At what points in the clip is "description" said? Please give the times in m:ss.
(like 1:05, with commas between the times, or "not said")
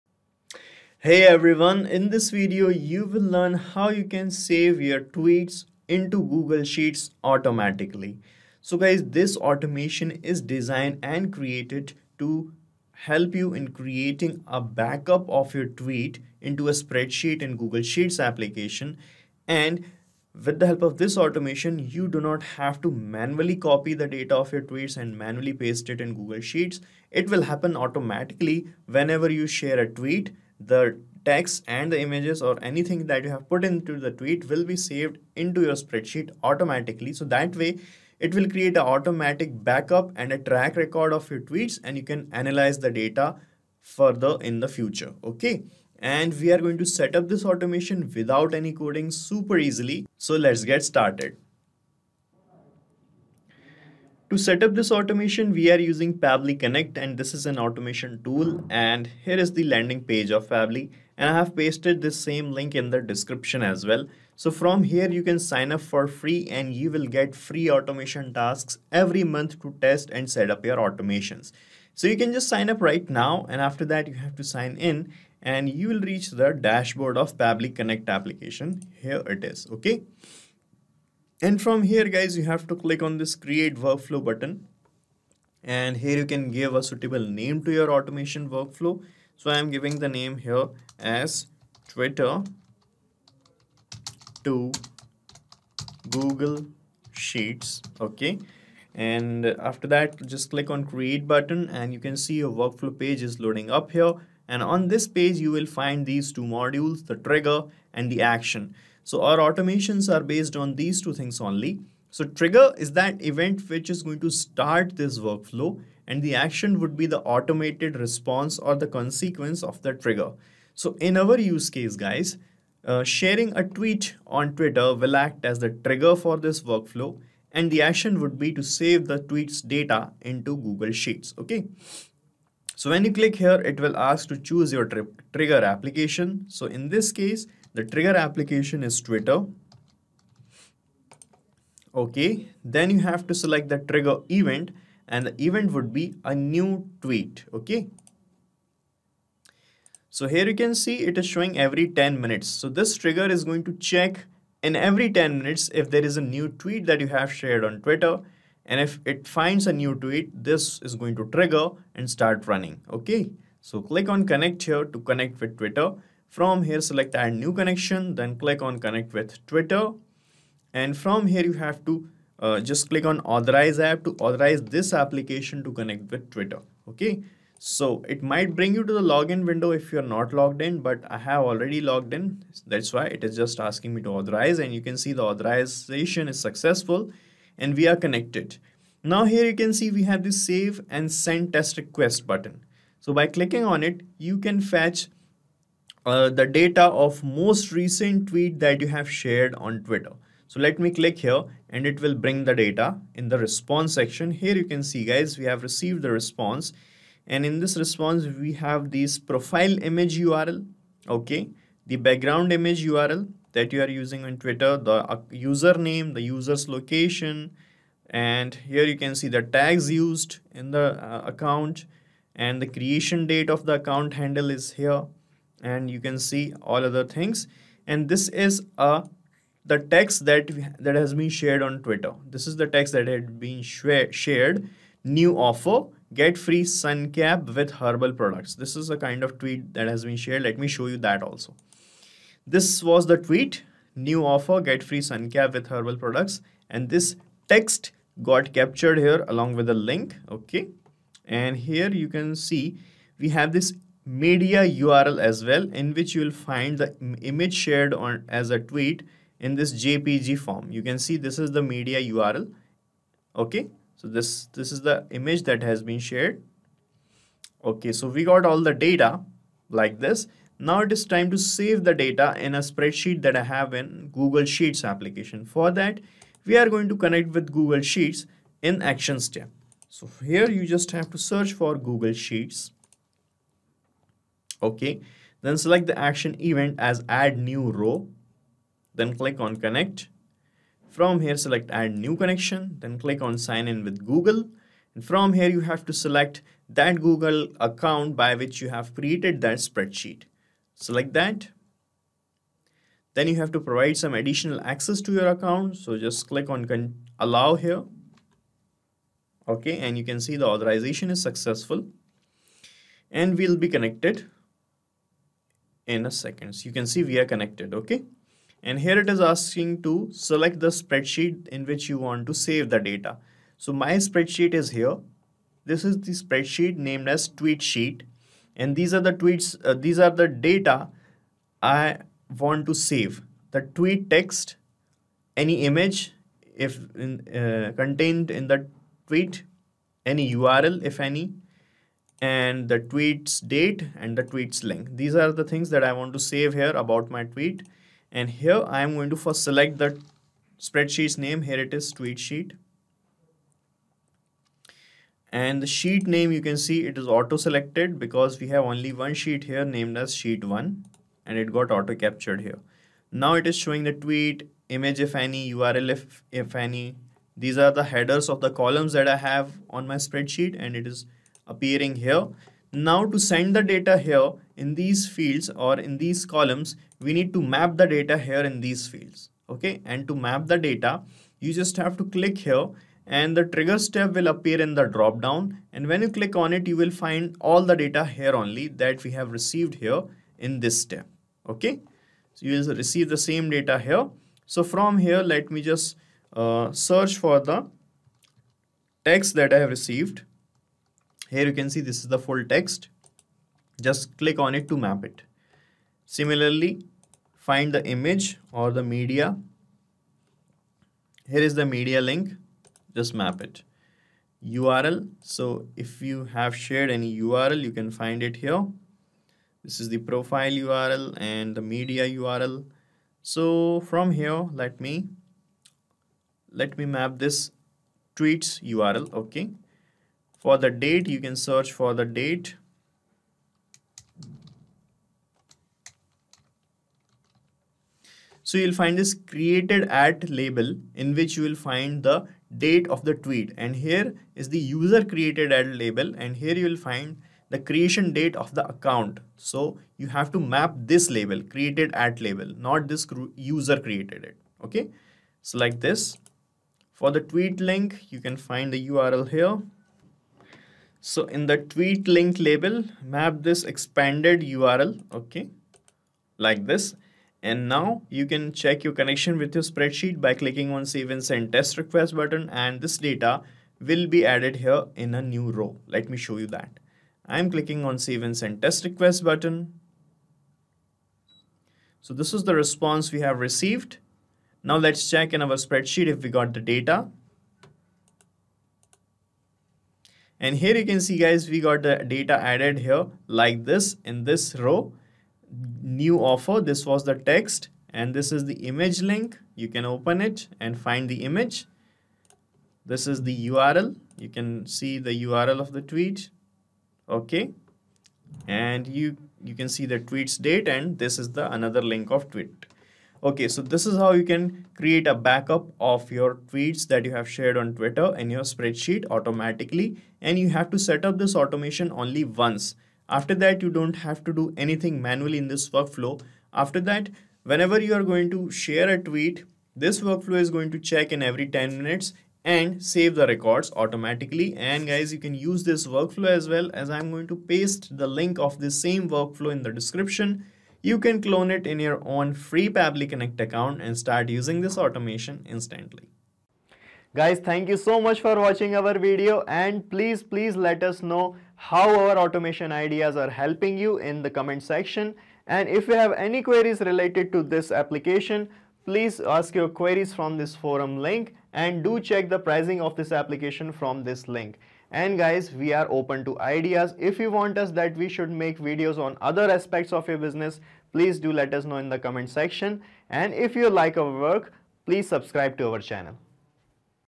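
1:03, 8:59.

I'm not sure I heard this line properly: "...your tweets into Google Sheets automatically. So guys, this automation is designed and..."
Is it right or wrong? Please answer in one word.
right.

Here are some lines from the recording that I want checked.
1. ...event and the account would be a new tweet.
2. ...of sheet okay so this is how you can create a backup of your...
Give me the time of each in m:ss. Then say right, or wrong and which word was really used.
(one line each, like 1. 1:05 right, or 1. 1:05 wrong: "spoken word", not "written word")
1. 2:24 wrong: "event", not "account"
2. 8:32 wrong: "tweet", not "sheet".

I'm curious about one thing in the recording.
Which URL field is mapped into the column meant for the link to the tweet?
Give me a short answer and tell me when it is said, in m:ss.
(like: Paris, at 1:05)
expanded url, at 7:43.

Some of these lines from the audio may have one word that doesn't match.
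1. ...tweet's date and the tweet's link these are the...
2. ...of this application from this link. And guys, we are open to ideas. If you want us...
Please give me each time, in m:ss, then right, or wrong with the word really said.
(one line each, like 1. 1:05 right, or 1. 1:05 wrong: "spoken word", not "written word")
1. 5:42 right
2. 9:22 right.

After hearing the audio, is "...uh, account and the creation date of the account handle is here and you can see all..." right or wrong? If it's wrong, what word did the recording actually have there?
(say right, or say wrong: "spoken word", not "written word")
right.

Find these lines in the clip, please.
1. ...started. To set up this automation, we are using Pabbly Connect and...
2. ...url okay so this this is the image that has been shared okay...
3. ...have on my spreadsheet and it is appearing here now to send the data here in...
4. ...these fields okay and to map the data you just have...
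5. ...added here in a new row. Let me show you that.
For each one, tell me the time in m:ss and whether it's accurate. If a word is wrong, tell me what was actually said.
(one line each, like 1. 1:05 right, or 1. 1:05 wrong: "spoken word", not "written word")
1. 0:50 right
2. 4:22 right
3. 6:09 right
4. 6:18 right
5. 7:54 right.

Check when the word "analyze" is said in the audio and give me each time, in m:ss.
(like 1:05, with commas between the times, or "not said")
0:42.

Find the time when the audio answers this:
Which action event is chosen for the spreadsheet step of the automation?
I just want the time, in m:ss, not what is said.
4:47.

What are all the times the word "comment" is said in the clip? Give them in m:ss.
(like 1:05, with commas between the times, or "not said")
9:14, 9:31.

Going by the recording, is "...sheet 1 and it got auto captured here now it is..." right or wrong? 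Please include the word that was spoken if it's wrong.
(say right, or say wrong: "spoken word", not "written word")
right.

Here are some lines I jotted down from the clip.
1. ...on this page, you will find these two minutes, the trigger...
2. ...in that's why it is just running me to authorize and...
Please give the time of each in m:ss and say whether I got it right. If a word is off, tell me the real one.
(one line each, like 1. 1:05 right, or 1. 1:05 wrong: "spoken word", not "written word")
1. 1:44 wrong: "modules", not "minutes"
2. 3:02 wrong: "asking", not "running".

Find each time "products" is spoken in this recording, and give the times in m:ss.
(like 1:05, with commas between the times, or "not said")
3:58, 4:05.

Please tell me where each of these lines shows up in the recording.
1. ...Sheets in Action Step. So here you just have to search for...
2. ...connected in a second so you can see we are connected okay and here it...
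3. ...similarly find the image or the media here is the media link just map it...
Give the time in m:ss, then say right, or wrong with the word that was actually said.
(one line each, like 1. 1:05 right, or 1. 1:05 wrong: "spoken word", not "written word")
1. 4:37 right
2. 5:13 right
3. 6:46 right.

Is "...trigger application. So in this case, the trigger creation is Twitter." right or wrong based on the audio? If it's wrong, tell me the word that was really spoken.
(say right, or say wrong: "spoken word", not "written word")
wrong: "application", not "creation".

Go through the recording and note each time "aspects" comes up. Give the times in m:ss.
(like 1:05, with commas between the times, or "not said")
9:29.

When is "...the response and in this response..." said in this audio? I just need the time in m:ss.
3:26.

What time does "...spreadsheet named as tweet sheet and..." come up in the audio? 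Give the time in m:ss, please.
5:26.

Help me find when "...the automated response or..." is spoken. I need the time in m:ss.
1:57.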